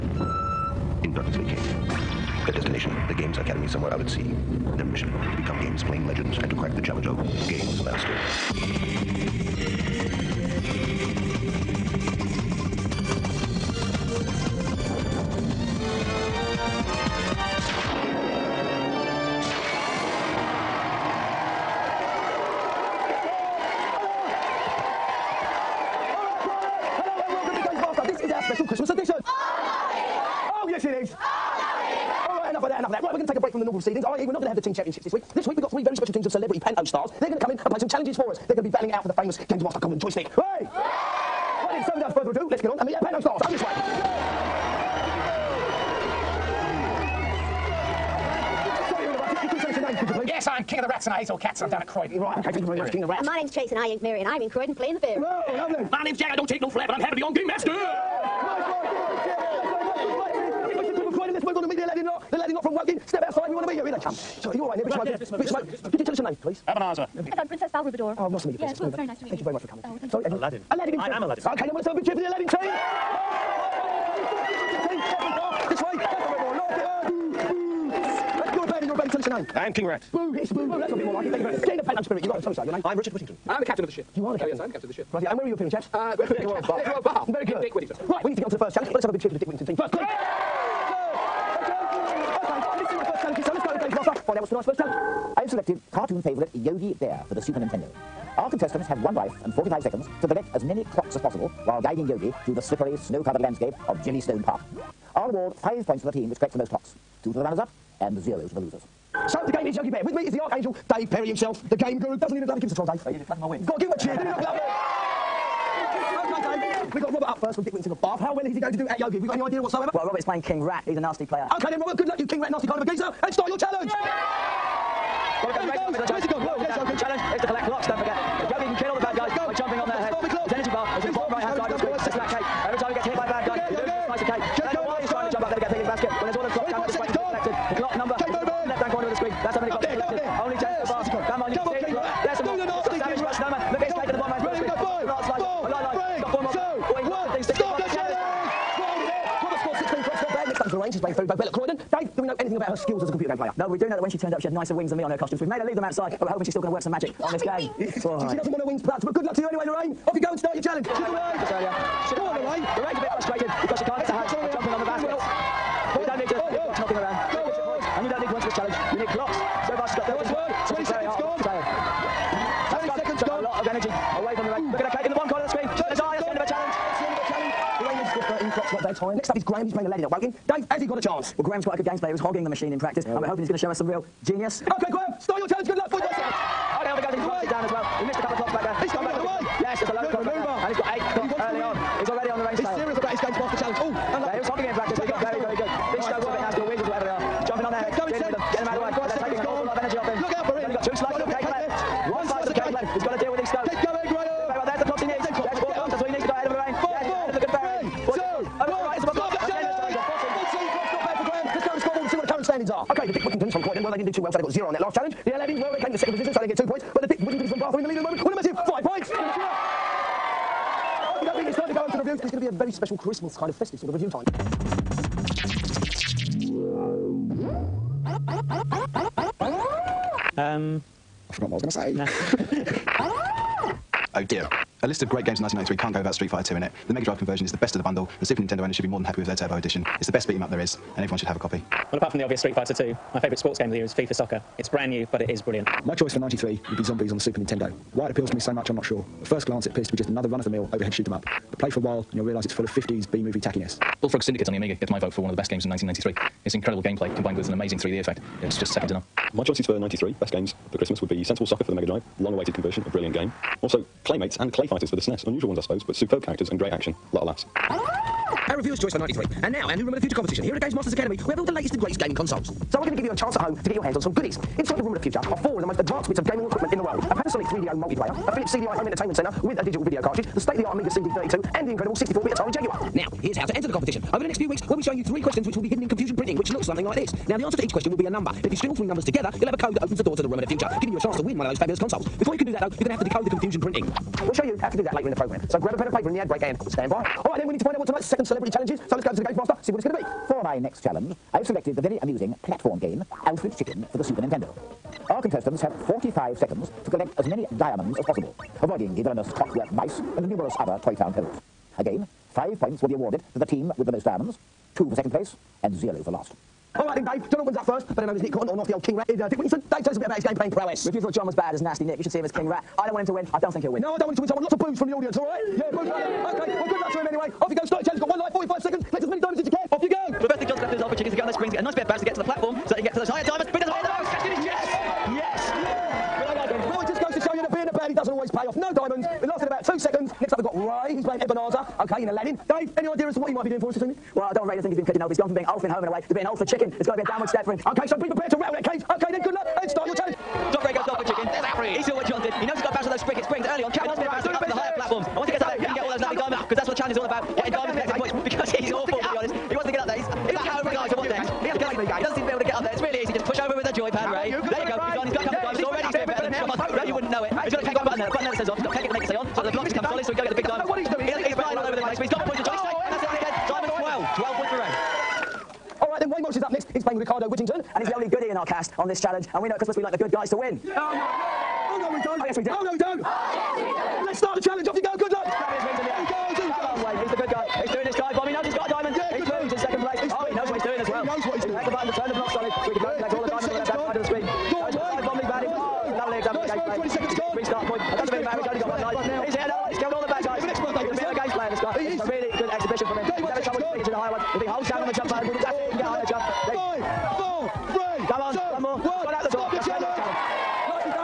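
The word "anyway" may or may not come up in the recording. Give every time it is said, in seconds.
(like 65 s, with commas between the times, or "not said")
159 s, 327 s.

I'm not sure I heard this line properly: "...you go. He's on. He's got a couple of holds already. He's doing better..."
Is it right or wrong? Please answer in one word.
wrong.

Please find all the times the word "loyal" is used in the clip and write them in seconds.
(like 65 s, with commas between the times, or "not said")
not said.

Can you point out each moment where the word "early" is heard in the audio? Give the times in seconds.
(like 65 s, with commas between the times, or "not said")
191 s, 353 s.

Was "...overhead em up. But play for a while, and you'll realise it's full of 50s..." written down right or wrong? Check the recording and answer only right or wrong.
right.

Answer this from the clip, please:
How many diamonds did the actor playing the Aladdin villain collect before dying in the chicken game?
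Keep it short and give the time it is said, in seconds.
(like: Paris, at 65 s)
12, at 373 s.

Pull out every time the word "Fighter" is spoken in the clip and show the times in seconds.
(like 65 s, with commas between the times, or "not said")
236 s, 242 s, 264 s.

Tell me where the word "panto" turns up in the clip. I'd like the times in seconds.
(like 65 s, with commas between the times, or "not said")
36 s, 43 s, 81 s.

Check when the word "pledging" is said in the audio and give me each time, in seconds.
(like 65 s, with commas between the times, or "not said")
344 s.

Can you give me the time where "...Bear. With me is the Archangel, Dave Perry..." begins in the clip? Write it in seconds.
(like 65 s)
109 s.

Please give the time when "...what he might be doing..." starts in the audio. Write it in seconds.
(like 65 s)
343 s.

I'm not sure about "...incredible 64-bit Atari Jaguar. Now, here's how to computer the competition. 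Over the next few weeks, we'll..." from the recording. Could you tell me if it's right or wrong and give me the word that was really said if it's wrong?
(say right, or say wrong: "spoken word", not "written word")
wrong: "enter", not "computer".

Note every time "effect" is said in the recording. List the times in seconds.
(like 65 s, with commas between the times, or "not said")
257 s.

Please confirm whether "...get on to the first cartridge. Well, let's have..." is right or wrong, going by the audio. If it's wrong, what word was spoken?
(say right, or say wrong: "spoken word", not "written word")
wrong: "challenge", not "cartridge".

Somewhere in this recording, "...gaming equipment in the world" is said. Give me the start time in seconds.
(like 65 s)
276 s.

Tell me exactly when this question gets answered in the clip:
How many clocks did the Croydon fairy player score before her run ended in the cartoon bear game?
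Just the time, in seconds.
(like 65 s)
178 s.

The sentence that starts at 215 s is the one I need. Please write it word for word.
The Aladdins, well, they came into second position, so they get two points.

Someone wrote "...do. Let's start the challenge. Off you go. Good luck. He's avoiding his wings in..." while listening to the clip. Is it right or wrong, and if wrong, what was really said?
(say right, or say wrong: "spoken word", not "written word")
wrong: "grabbing", not "avoiding".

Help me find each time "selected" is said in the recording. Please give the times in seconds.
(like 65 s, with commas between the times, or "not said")
95 s, 301 s.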